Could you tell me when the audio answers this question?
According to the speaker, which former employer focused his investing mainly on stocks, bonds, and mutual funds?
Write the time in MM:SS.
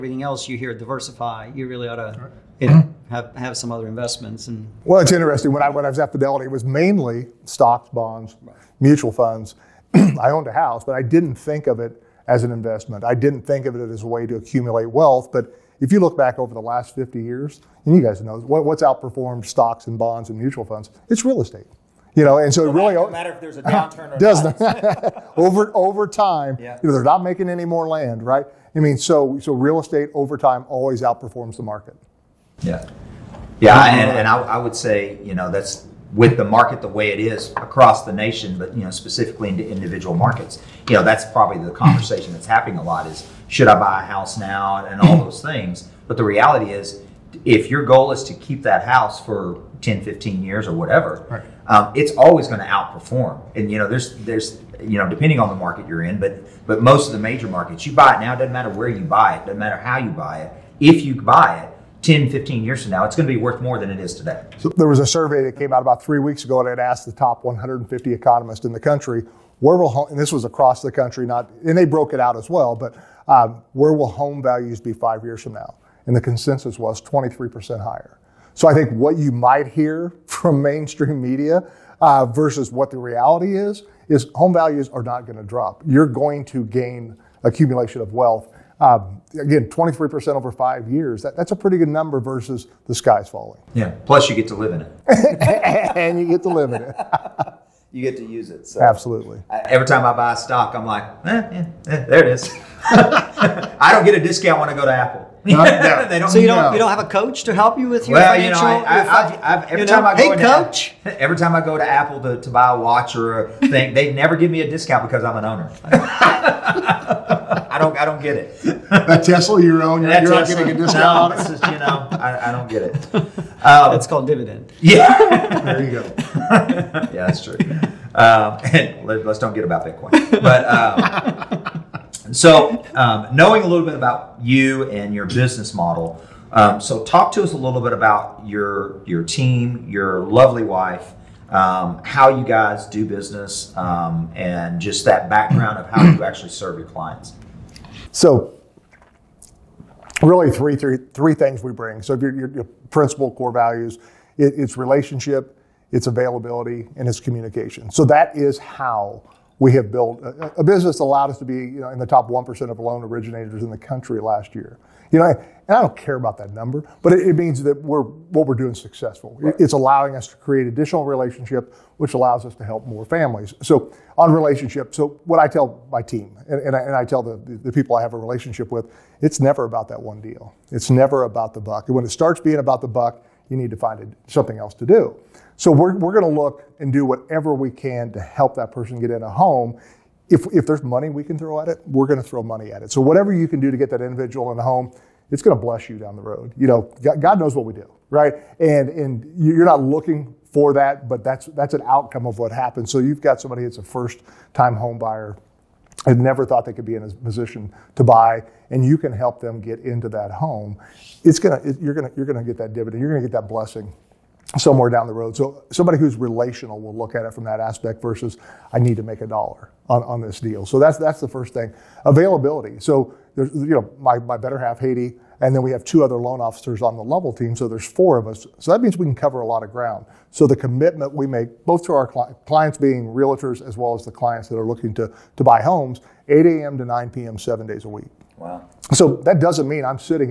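00:06.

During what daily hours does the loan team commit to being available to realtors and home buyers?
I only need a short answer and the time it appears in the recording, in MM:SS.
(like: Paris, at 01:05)
8 a.m. to 9 p.m., at 03:56.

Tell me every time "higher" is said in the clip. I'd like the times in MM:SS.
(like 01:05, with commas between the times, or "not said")
01:17.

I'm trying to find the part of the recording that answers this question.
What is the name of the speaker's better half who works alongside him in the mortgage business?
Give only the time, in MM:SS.
03:44.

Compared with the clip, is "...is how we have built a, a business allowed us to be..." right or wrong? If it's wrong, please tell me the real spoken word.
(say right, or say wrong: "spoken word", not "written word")
right.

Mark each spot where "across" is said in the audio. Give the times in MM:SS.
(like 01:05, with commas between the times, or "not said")
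00:37, 01:10.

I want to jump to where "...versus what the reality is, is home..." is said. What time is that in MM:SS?
01:22.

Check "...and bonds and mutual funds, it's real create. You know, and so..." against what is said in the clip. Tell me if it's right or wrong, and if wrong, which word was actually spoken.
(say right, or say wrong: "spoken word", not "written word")
wrong: "estate", not "create".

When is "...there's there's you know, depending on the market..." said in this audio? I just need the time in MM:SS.
00:53.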